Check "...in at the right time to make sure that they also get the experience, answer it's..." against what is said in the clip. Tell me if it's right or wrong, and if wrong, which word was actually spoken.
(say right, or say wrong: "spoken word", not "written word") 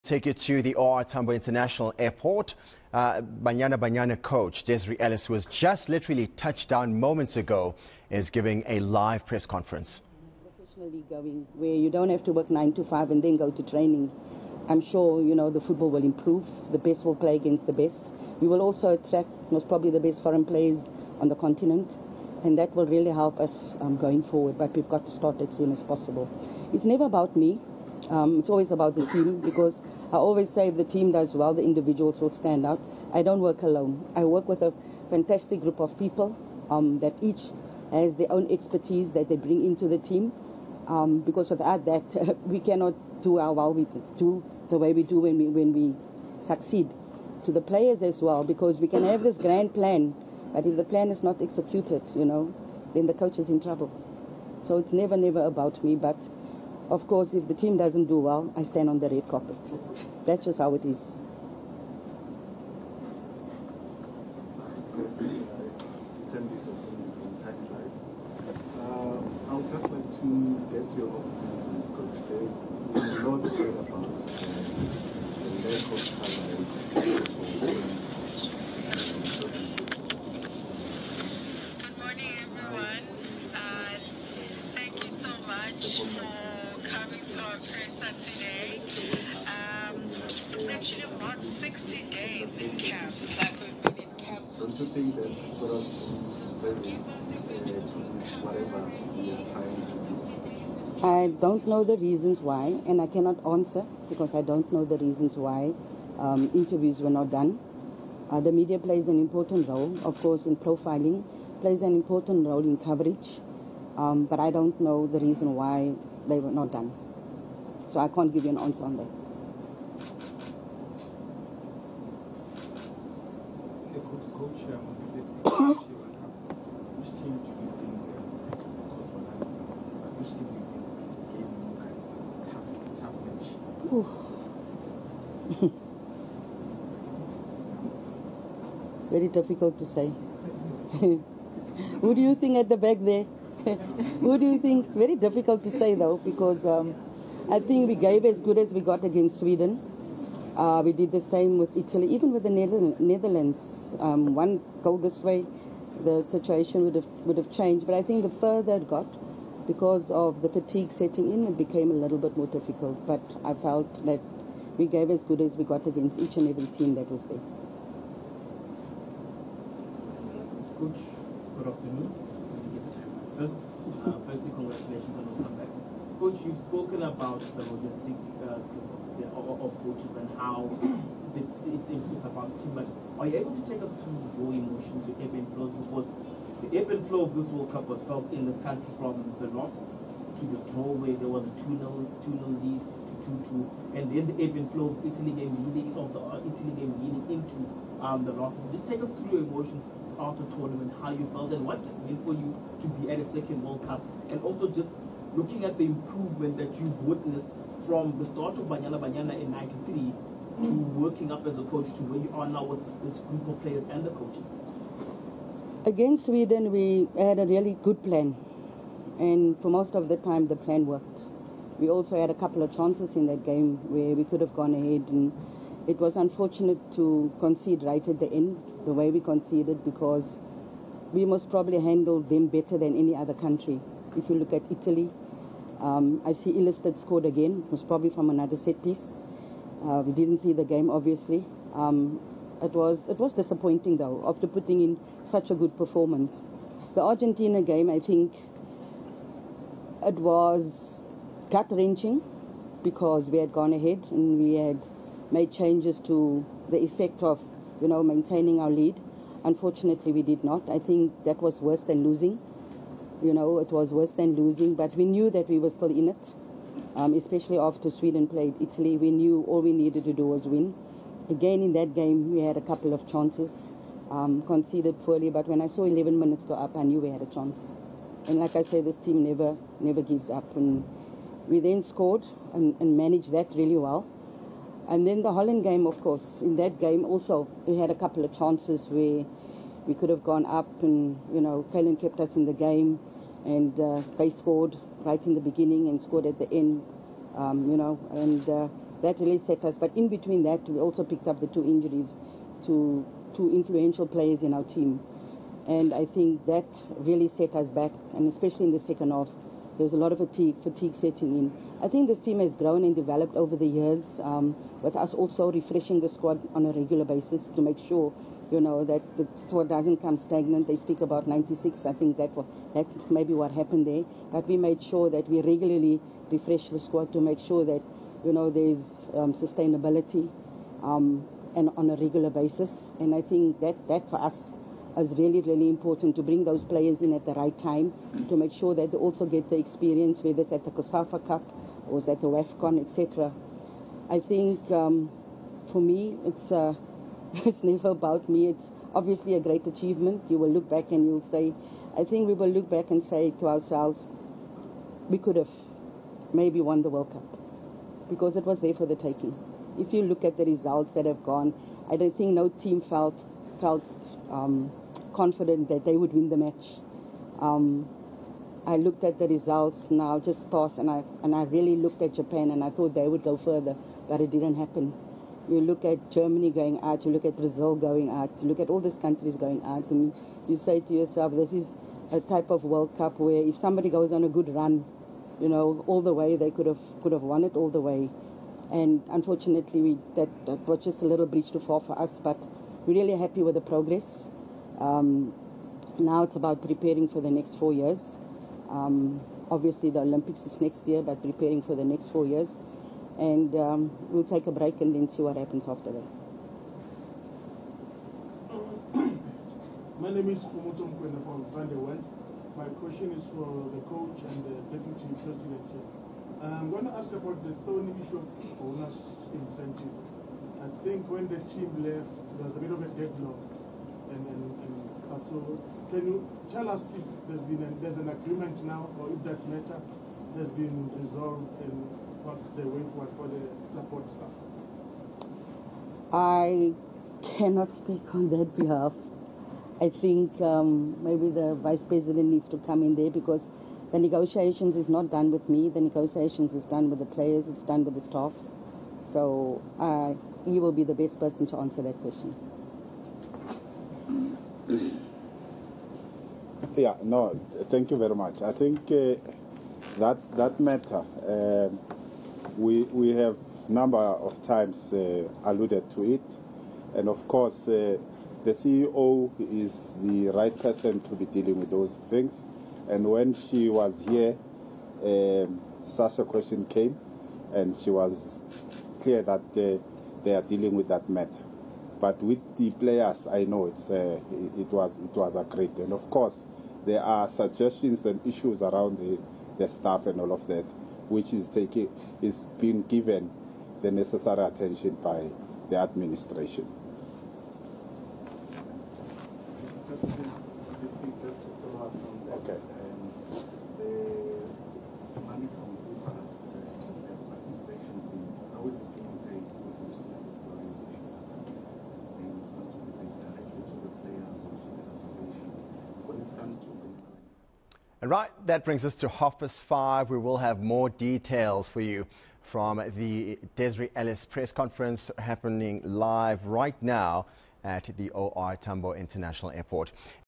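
wrong: "whether", not "answer".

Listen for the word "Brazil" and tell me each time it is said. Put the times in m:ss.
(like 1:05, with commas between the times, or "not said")
6:17.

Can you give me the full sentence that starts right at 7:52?
And when she was here, um, such a question came, and she was clear that uh, they are dealing with that matter.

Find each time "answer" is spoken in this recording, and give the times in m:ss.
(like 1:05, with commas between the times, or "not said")
1:43, 1:58, 7:31.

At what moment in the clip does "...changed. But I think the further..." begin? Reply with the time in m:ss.
2:37.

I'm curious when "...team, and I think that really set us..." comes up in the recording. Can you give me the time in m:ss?
5:04.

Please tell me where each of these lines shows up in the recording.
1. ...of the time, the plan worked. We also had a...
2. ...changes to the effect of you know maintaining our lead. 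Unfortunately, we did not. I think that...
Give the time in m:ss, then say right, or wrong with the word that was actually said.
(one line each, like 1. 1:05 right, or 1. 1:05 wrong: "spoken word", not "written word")
1. 3:39 right
2. 4:15 right.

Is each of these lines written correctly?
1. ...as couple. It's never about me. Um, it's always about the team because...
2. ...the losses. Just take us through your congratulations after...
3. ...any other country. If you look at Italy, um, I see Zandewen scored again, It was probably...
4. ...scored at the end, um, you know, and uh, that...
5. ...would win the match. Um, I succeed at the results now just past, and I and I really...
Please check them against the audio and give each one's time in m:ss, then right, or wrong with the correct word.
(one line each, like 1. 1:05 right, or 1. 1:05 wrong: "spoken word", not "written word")
1. 0:25 wrong: "possible", not "couple"
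2. 3:18 wrong: "emotions", not "congratulations"
3. 3:52 wrong: "Illisted", not "Zandewen"
4. 4:56 right
5. 6:05 wrong: "looked", not "succeed".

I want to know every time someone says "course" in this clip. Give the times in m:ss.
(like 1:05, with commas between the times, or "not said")
0:57, 1:50, 4:46, 7:47, 8:06.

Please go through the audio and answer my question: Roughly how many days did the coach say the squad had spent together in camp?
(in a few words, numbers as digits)
60.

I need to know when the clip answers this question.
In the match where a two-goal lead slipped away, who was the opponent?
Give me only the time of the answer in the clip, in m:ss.
4:07.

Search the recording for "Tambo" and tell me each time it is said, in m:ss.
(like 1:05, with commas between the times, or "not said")
0:01, 8:48.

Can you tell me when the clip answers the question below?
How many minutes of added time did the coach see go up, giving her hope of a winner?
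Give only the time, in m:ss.
4:35.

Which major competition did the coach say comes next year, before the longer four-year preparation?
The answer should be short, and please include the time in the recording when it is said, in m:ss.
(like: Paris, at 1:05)
Olympics, at 6:39.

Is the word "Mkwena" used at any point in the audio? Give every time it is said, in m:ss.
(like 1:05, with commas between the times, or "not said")
6:50.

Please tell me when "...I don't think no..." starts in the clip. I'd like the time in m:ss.
6:01.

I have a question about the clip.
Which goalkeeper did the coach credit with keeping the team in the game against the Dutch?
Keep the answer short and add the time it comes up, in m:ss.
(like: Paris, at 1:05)
Kaylin, at 4:51.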